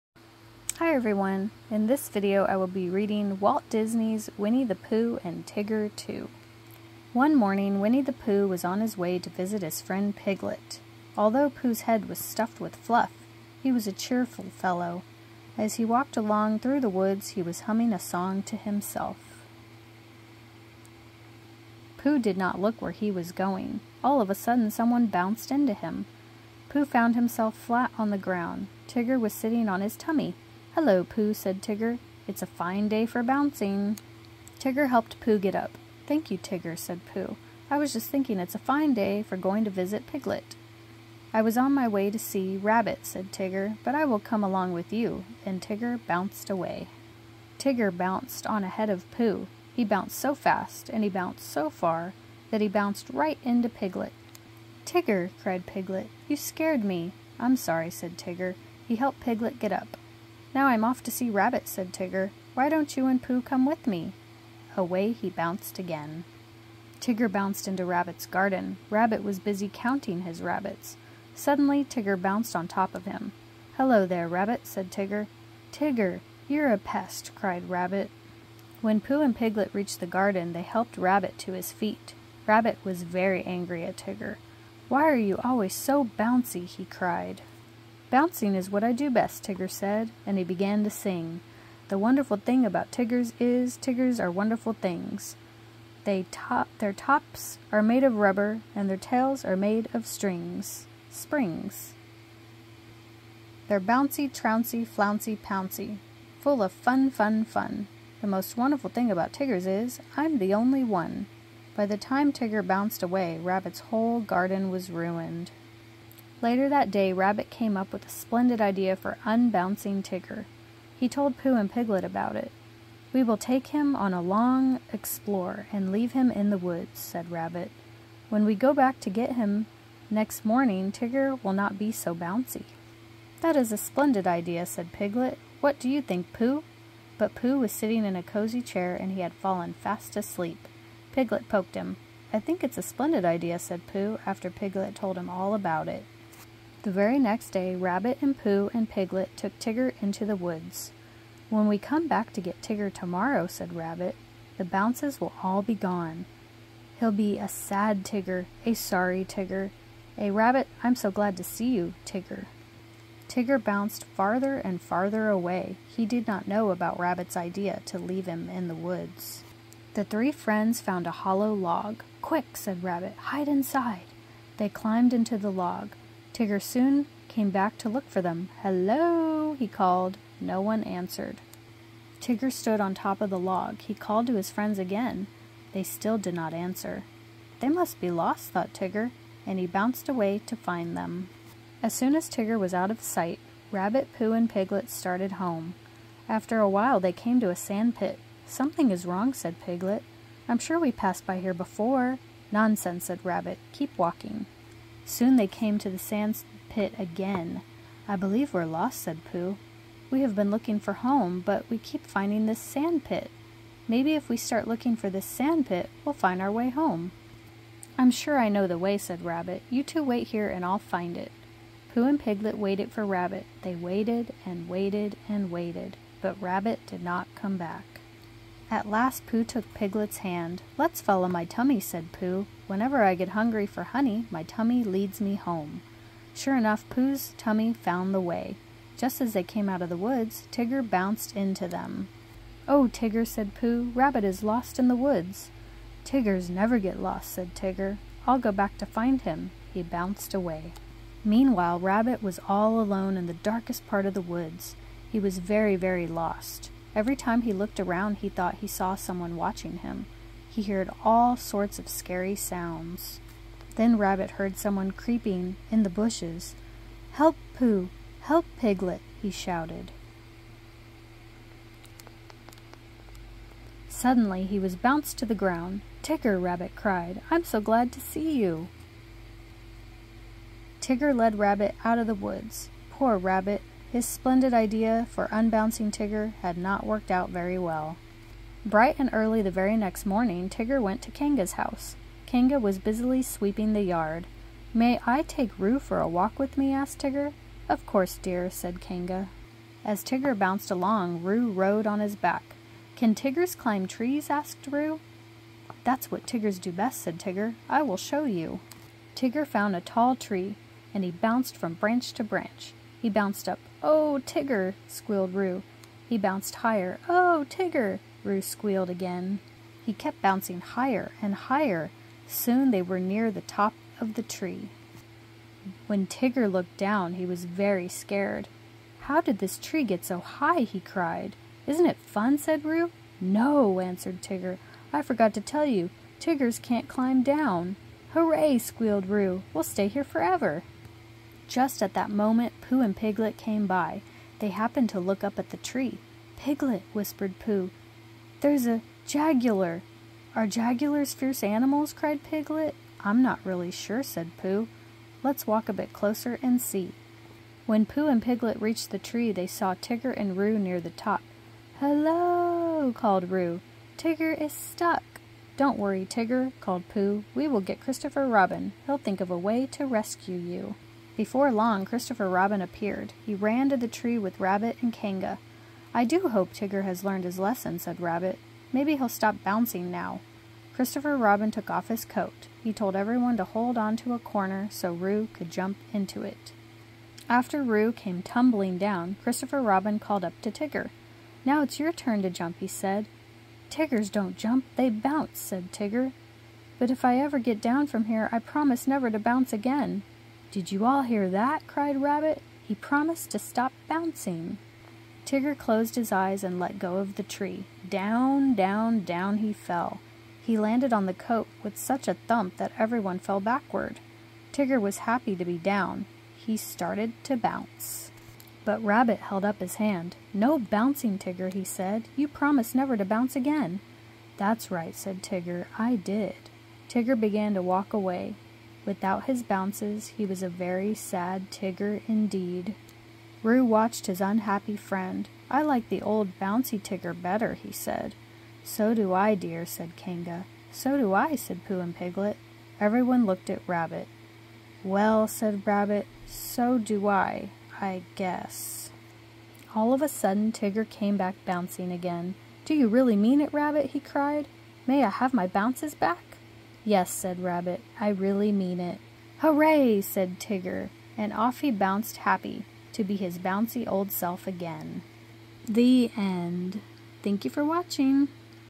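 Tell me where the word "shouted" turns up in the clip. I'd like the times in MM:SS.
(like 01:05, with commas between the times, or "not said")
04:29.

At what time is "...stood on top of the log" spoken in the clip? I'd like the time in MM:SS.
03:02.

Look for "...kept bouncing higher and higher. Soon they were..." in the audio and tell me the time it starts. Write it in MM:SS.
05:19.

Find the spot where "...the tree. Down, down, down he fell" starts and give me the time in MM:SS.
06:47.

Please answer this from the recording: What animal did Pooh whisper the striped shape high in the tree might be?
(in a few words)
A jaguar.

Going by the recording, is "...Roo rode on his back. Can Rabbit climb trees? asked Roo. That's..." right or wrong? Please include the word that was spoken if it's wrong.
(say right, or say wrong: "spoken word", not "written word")
wrong: "Tiggers", not "Rabbit".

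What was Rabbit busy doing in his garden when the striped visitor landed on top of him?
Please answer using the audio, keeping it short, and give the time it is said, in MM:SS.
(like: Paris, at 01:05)
Counting his rabbits, at 01:09.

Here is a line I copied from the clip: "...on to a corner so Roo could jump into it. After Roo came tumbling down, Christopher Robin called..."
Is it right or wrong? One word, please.
right.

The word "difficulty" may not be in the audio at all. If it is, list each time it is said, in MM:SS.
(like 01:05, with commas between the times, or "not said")
not said.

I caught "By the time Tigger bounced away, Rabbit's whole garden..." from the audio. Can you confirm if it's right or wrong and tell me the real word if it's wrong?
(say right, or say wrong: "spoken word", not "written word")
right.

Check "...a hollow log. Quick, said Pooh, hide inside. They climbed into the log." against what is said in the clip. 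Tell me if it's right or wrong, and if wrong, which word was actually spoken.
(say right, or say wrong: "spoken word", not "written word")
wrong: "Rabbit", not "Pooh".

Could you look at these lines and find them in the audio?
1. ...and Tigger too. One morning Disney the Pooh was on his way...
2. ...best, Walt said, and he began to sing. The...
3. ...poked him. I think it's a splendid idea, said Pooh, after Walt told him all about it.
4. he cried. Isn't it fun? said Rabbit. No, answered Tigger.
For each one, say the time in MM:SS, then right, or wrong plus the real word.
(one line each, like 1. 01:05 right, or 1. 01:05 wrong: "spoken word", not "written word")
1. 00:05 wrong: "Winnie", not "Disney"
2. 01:29 wrong: "Tigger", not "Walt"
3. 02:21 wrong: "Piglet", not "Walt"
4. 05:30 wrong: "Roo", not "Rabbit".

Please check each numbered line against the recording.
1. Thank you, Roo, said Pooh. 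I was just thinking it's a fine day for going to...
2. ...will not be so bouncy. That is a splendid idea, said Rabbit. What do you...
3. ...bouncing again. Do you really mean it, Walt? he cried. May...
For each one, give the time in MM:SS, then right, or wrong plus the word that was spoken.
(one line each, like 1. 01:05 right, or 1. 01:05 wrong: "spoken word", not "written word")
1. 00:36 wrong: "Tigger", not "Roo"
2. 02:11 wrong: "Piglet", not "Rabbit"
3. 07:31 wrong: "Rabbit", not "Walt".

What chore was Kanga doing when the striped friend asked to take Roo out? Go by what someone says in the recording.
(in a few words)
Sweeping the yard.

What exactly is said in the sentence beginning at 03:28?
I believe we're lost, said Pooh.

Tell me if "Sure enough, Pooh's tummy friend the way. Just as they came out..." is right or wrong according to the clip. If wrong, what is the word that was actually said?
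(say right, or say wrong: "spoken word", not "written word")
wrong: "found", not "friend".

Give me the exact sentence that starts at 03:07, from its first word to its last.
They must be lost, thought Tigger, and he bounced away to find them.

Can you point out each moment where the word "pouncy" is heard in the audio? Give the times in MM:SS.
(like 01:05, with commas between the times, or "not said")
01:45.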